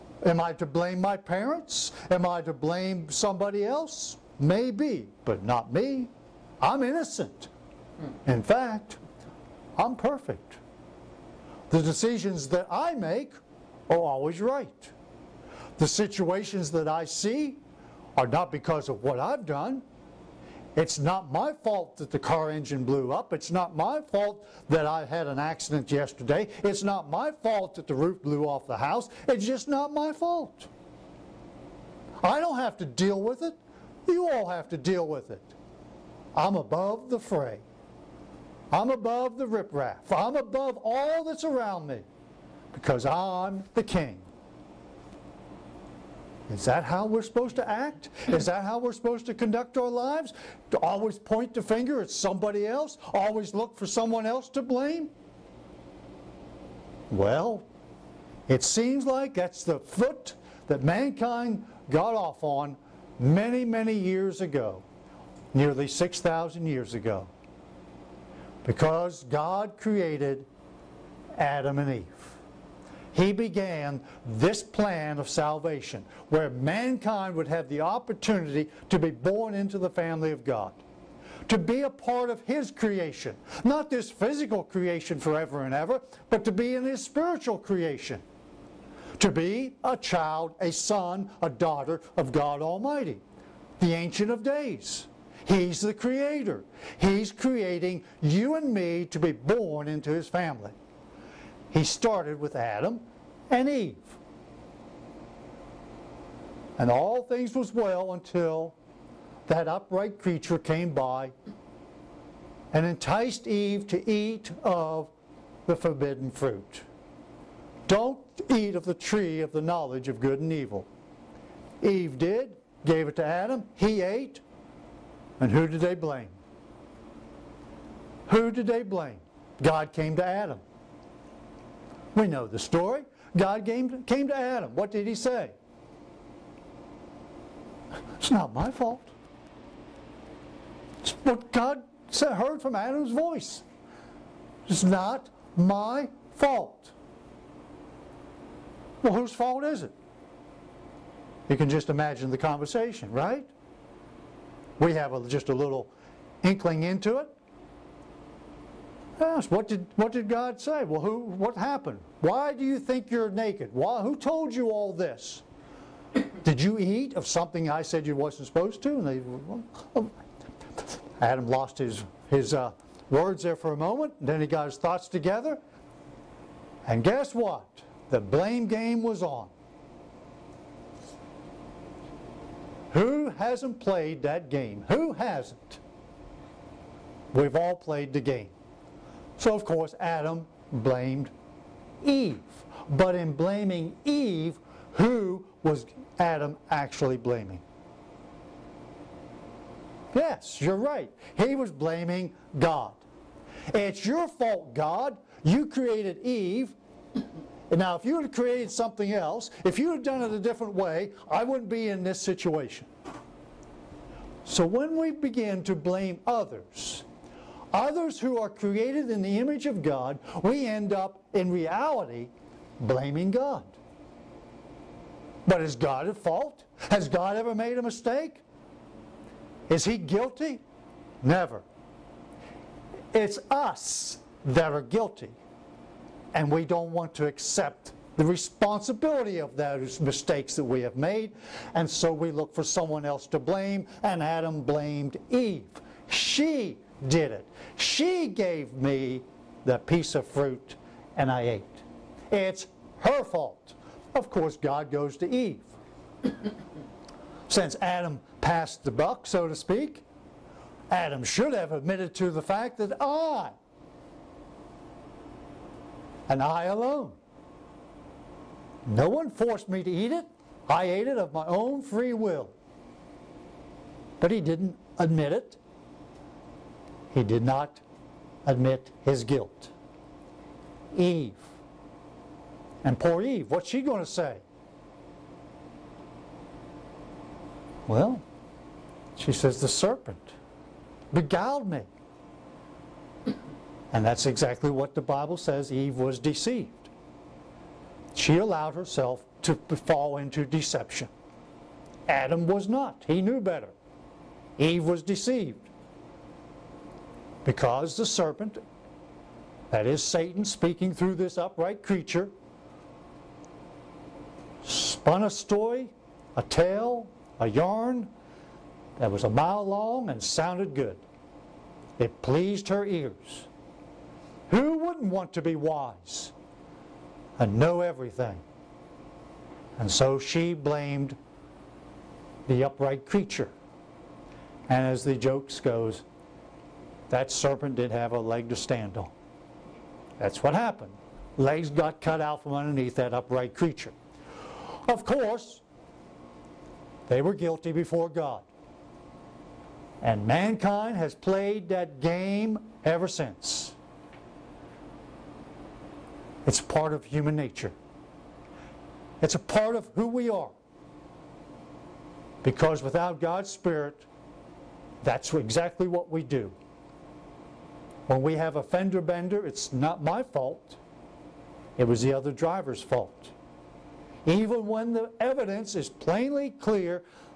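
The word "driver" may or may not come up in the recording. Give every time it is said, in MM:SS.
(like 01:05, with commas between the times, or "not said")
06:12.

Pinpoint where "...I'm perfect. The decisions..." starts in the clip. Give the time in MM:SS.
00:09.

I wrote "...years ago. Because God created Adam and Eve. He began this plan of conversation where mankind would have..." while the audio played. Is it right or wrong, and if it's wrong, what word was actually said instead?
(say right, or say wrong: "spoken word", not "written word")
wrong: "salvation", not "conversation".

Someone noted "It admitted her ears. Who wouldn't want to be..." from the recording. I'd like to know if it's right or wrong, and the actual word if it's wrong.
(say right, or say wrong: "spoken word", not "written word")
wrong: "pleased", not "admitted".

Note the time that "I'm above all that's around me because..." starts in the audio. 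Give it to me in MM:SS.
00:40.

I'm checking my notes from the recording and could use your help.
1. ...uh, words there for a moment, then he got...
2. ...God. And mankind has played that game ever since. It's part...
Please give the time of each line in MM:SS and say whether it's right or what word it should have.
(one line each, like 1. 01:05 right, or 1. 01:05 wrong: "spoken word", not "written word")
1. 02:52 right
2. 05:48 right.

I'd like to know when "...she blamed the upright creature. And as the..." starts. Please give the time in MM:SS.
05:30.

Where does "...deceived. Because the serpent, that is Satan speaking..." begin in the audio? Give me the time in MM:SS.
05:05.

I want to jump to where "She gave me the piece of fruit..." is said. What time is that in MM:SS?
04:07.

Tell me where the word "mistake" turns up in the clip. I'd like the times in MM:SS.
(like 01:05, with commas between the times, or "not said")
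03:47, 04:00.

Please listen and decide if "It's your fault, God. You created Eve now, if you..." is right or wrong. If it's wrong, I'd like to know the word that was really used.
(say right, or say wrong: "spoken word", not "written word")
right.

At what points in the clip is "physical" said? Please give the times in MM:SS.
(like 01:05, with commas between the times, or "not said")
01:24.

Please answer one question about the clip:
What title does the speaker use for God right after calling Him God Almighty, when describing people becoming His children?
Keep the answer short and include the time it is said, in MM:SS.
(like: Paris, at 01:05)
the Ancient of Days, at 01:33.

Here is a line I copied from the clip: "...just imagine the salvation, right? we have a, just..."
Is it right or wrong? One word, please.
wrong.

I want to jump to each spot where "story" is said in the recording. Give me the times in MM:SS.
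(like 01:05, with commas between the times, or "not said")
02:12, 05:15.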